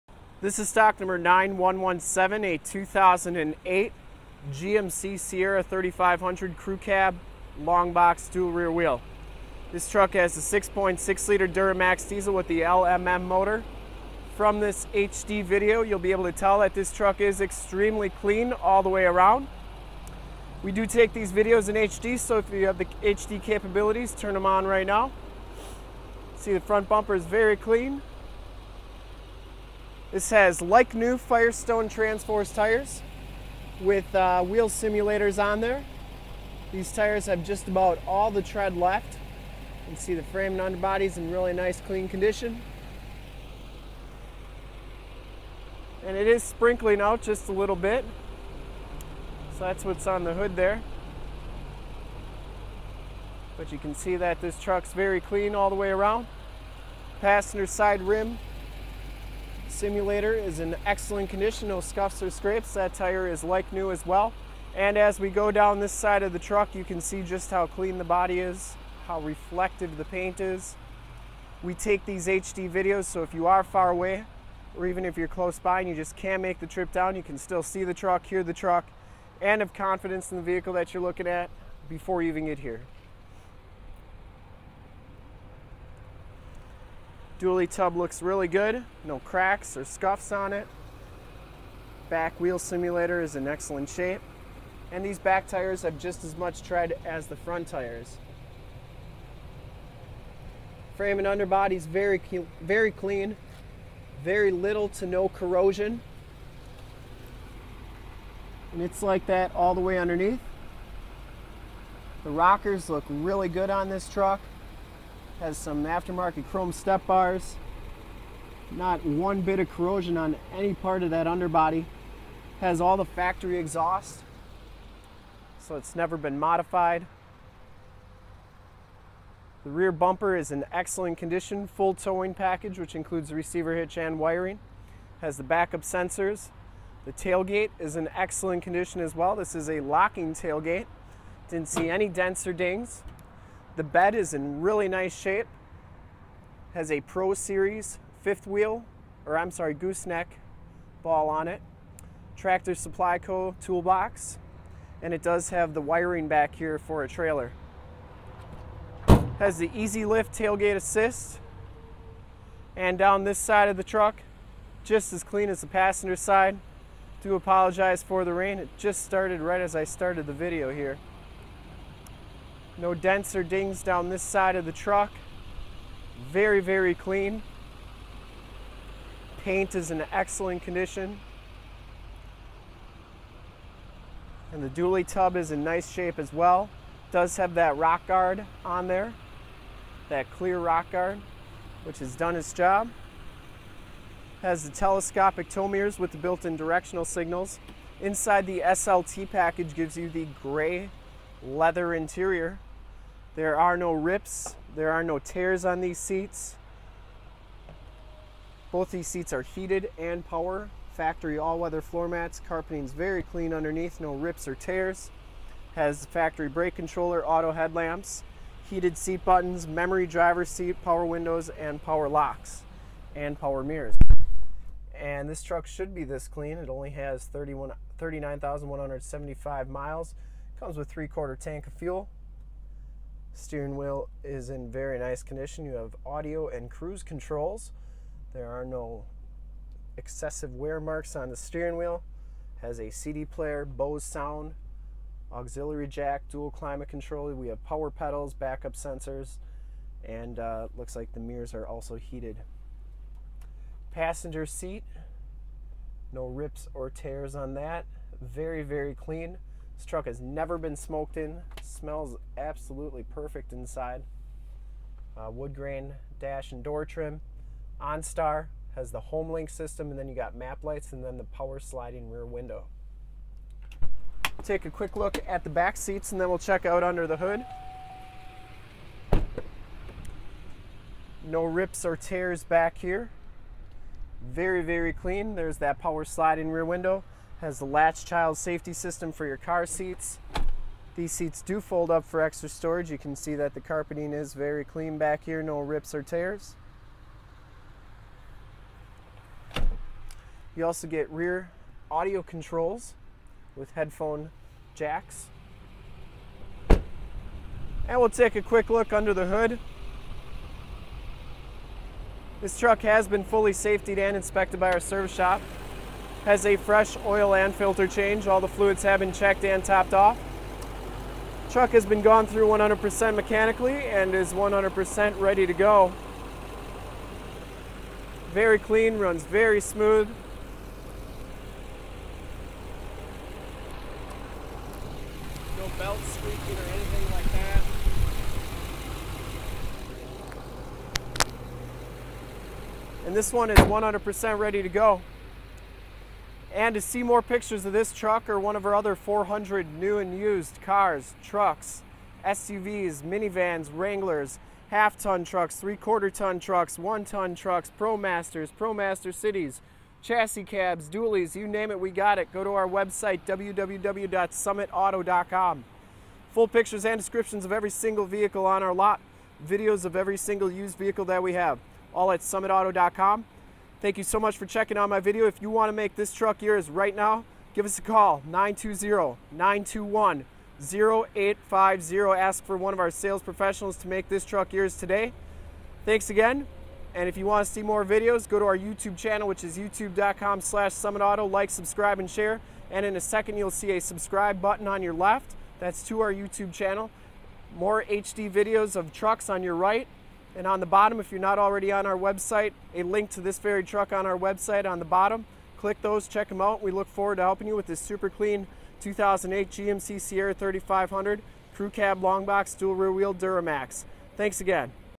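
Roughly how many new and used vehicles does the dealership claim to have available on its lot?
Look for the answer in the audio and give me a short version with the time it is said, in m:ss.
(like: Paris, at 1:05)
400, at 5:48.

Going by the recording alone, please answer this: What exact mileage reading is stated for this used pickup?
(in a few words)
39,175.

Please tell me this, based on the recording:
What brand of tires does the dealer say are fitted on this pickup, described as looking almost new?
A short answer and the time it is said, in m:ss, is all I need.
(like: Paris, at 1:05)
Firestone Transforce, at 0:31.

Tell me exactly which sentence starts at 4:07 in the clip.
We have power pedals, backup sensors, and uh, looks like the mirrors are also heated.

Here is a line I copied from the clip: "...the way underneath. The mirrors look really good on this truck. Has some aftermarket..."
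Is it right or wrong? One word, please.
wrong.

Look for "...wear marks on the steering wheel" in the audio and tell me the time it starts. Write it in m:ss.
4:00.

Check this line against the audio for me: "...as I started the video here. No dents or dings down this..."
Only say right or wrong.
right.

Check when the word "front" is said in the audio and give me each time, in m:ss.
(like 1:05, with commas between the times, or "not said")
0:26, 1:37.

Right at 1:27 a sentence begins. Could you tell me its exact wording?
Dually tub looks really good, no cracks or scuffs on it.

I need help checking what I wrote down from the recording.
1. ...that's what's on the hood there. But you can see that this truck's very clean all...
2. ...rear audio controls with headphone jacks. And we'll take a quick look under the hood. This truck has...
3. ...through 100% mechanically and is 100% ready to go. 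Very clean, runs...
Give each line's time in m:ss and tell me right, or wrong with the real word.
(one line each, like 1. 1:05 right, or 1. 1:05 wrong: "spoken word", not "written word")
1. 0:49 right
2. 5:01 right
3. 5:22 right.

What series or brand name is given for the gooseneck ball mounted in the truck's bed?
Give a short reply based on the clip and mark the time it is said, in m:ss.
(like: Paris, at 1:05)
Pro Series, at 2:27.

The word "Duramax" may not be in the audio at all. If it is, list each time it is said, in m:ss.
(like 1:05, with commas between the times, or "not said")
0:11, 6:53.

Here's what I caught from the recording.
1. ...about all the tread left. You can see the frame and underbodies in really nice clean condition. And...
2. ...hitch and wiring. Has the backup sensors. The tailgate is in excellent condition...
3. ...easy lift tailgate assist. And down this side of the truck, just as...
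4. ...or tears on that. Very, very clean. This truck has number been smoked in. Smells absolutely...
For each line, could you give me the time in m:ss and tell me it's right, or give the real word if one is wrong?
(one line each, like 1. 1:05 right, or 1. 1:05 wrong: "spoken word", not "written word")
1. 0:37 right
2. 2:13 right
3. 2:39 right
4. 4:16 wrong: "never", not "number".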